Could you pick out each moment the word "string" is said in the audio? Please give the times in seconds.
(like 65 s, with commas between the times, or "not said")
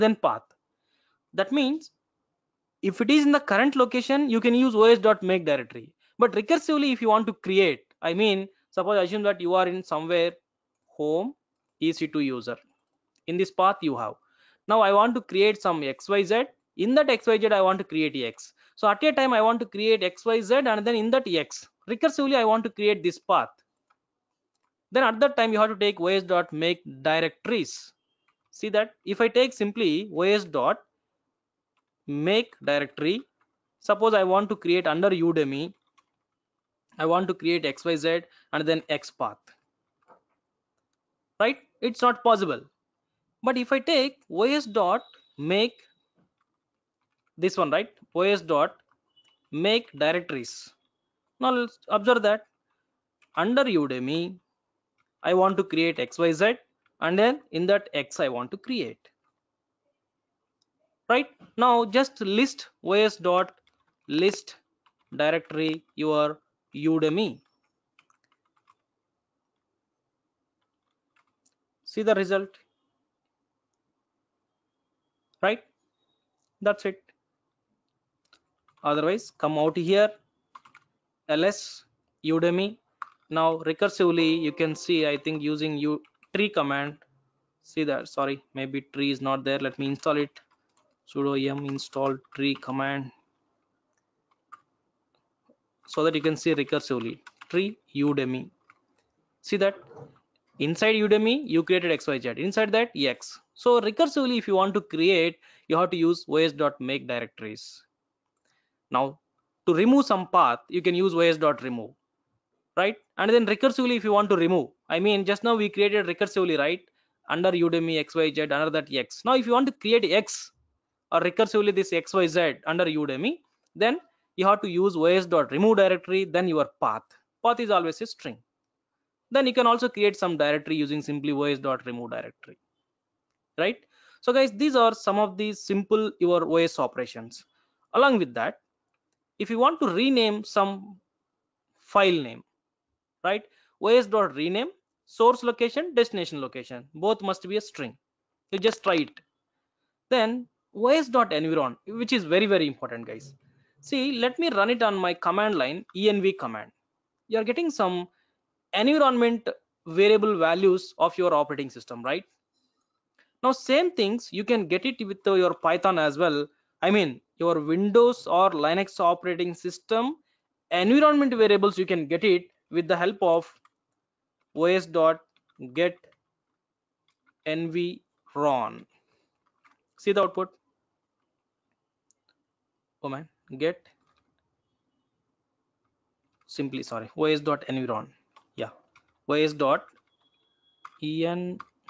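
128 s, 147 s.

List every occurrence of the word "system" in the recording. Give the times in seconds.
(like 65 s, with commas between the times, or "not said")
161 s, 169 s.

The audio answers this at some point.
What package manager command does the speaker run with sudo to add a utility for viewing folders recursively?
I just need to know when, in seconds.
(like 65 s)
91 s.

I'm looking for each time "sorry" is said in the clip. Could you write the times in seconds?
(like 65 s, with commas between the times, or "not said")
88 s, 186 s.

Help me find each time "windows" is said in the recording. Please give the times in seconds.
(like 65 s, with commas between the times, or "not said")
167 s.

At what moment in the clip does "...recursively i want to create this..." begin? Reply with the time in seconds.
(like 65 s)
21 s.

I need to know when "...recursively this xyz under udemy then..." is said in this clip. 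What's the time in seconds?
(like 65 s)
121 s.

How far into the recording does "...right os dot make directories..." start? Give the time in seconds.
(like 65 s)
47 s.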